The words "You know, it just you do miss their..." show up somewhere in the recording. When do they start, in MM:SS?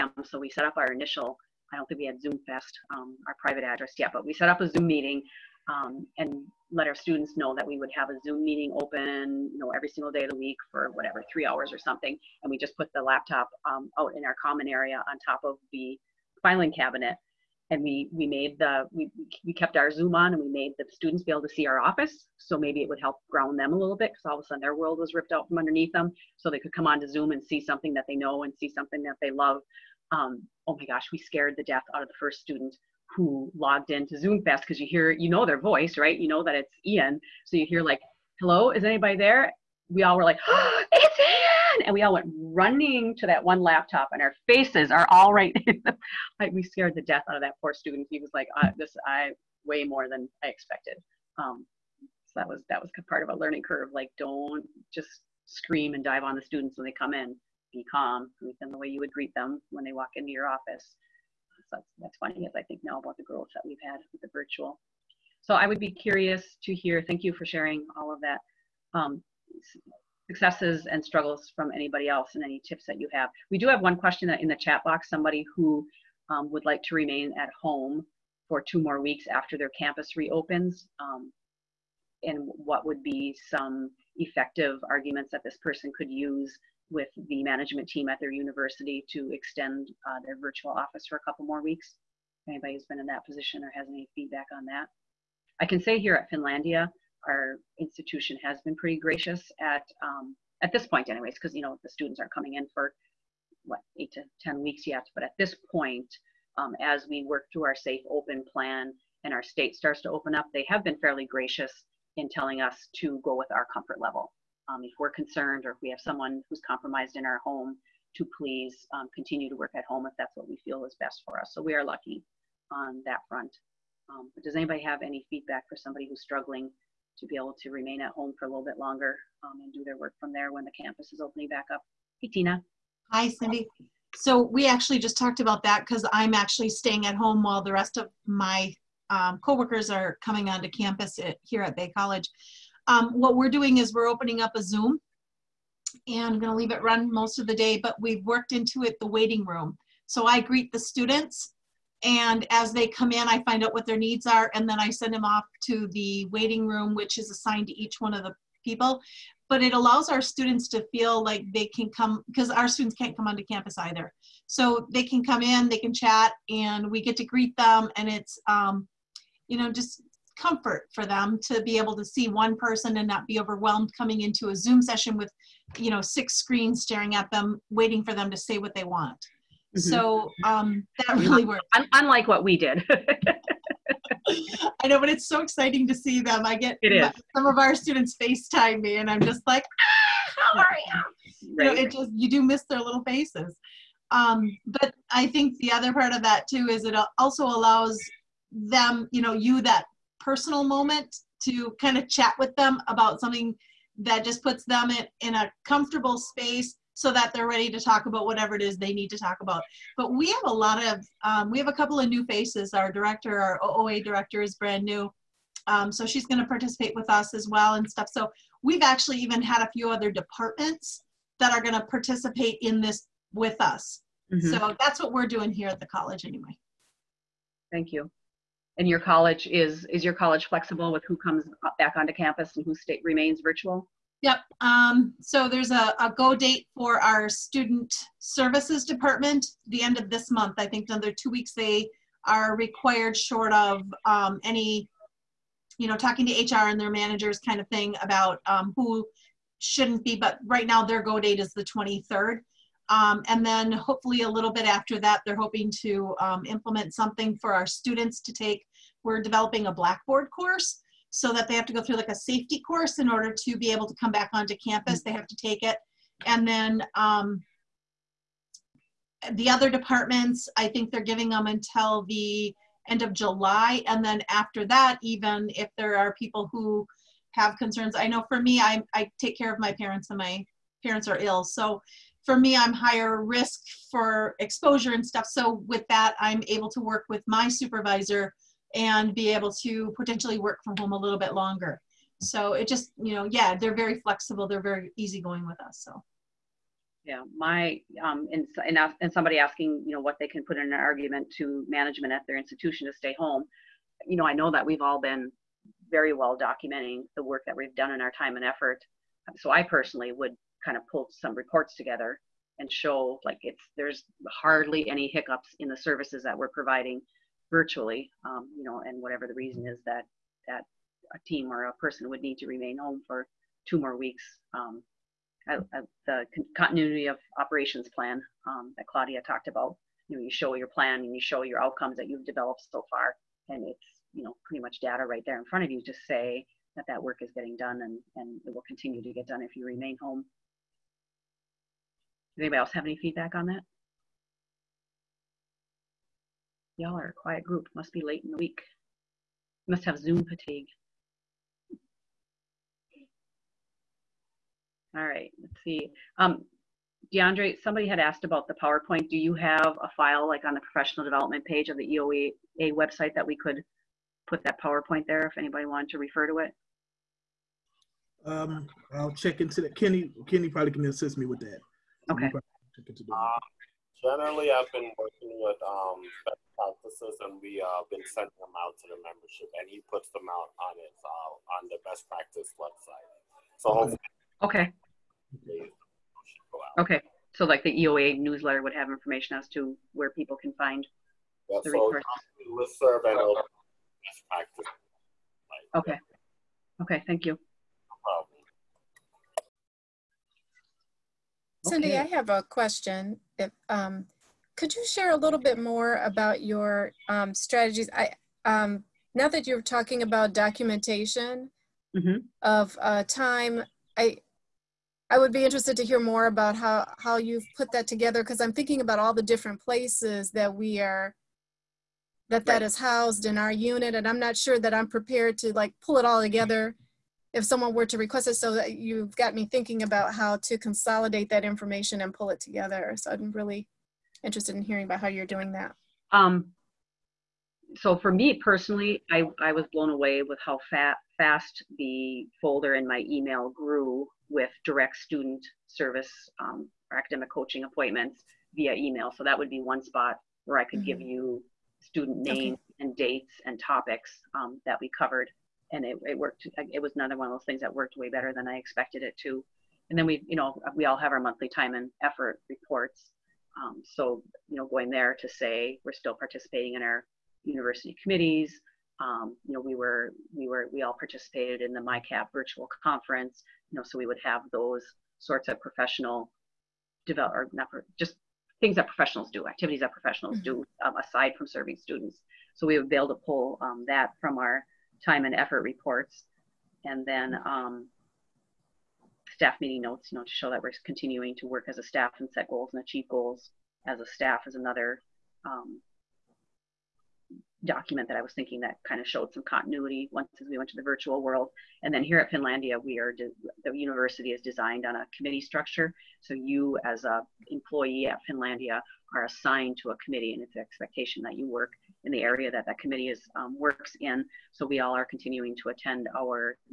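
03:11.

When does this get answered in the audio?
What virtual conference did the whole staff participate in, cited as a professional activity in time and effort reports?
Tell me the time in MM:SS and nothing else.
07:51.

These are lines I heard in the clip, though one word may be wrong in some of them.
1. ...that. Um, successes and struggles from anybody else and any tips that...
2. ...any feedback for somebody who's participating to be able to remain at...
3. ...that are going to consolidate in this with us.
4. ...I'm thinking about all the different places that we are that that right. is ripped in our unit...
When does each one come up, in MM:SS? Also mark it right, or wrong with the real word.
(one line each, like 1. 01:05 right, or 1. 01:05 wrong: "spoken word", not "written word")
1. 01:08 right
2. 02:05 wrong: "struggling", not "participating"
3. 03:41 wrong: "participate", not "consolidate"
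4. 06:58 wrong: "housed", not "ripped".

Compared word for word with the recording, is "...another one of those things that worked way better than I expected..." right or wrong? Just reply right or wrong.
right.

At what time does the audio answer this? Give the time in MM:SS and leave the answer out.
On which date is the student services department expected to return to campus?
04:11.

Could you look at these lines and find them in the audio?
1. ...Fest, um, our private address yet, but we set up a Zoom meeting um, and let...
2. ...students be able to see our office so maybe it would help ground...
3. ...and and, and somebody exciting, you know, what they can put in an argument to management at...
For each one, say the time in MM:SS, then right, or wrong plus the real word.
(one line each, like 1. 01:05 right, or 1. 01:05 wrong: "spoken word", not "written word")
1. 00:02 right
2. 00:20 right
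3. 04:58 wrong: "asking", not "exciting".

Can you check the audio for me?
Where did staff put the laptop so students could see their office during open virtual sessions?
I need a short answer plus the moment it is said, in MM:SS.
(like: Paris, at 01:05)
On top of the filing cabinet, at 00:15.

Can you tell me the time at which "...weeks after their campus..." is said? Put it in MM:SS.
01:18.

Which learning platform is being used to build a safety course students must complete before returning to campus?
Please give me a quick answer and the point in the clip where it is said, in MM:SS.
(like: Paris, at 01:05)
Blackboard, at 04:19.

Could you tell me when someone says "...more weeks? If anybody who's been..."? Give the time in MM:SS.
01:31.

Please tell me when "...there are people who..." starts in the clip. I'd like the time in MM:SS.
04:35.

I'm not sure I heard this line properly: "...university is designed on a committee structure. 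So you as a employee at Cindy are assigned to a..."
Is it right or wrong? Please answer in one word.
wrong.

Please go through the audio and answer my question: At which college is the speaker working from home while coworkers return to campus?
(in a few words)
Bay College.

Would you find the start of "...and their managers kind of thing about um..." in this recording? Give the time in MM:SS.
04:06.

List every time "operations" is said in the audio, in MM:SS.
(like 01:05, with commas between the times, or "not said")
05:27.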